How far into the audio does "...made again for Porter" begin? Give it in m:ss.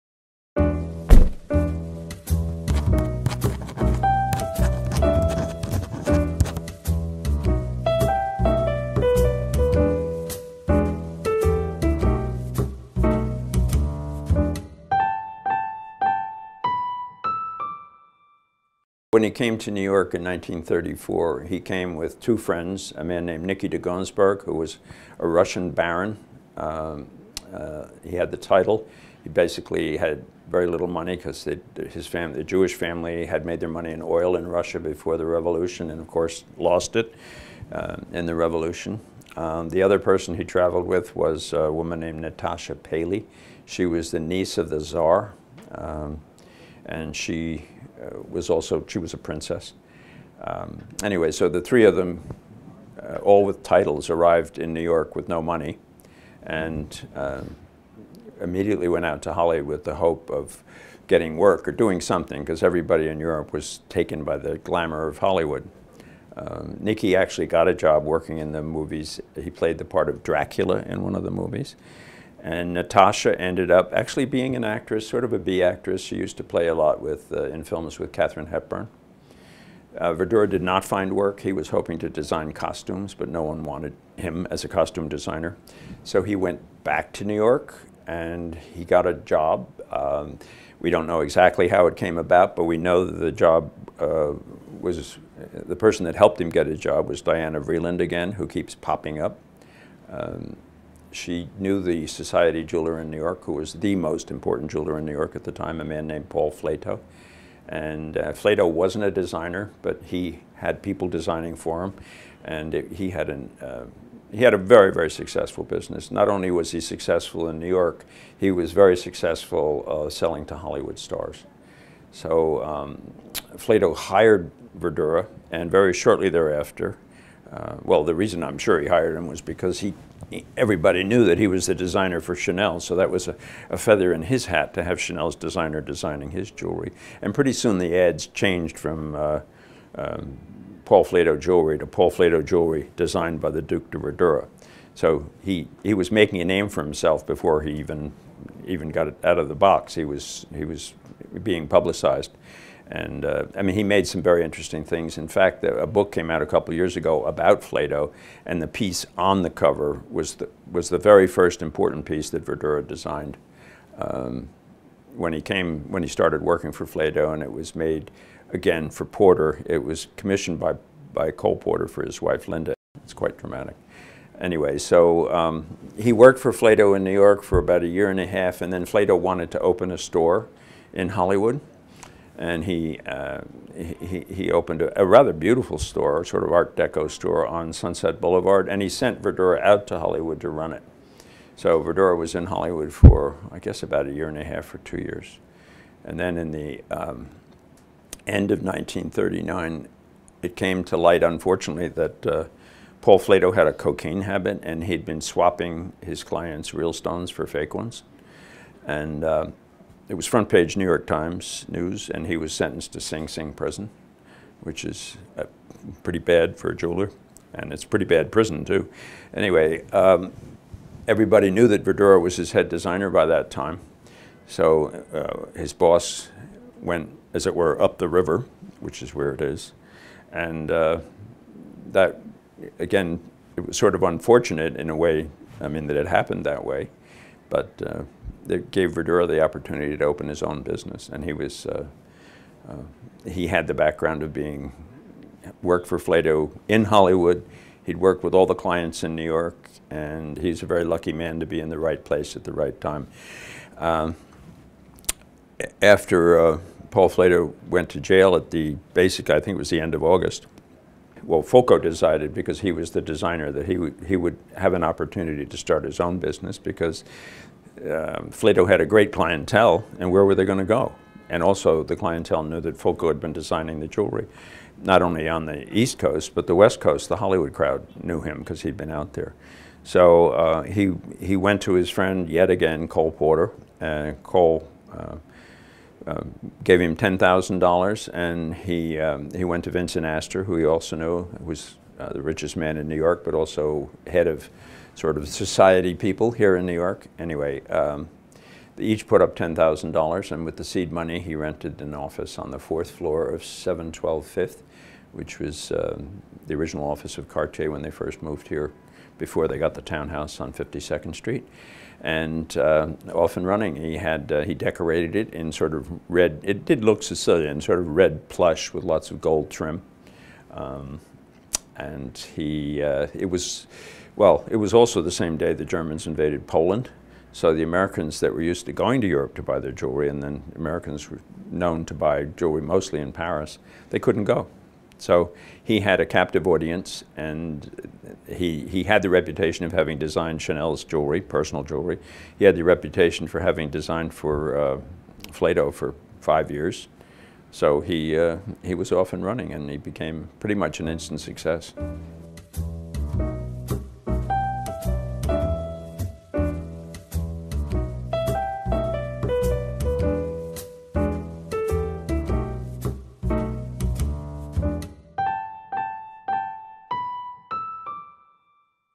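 2:47.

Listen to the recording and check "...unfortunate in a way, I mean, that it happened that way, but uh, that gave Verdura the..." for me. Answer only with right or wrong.
right.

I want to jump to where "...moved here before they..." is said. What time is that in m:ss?
5:08.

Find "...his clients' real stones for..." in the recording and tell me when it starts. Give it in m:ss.
3:26.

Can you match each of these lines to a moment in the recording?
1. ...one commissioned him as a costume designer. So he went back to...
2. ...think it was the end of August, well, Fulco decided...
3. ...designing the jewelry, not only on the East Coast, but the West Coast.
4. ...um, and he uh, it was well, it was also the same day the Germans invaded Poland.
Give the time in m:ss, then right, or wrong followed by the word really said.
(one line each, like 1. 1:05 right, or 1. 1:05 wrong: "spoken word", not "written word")
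1. 1:23 wrong: "wanted", not "commissioned"
2. 4:19 right
3. 4:33 right
4. 5:20 right.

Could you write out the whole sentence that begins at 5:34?
So he had a captive audience, and he, he had the reputation of having designed Chanel's jewelry, personal jewelry.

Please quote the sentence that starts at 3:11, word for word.
So Verdura was in Hollywood for, I guess, about a year and a half or two years.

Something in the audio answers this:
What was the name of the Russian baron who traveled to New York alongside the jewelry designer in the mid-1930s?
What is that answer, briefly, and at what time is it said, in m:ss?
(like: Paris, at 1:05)
Nicky de Gunzburg, at 0:23.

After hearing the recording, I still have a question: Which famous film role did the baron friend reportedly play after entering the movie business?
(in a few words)
Dracula.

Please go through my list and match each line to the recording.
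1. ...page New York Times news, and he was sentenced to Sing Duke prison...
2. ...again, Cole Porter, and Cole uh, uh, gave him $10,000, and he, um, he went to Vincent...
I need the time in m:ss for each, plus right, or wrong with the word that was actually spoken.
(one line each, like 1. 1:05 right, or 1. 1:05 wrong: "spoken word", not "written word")
1. 3:30 wrong: "Sing", not "Duke"
2. 4:42 right.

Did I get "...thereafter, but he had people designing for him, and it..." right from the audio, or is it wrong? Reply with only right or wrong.
wrong.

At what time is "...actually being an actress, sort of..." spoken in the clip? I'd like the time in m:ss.
1:13.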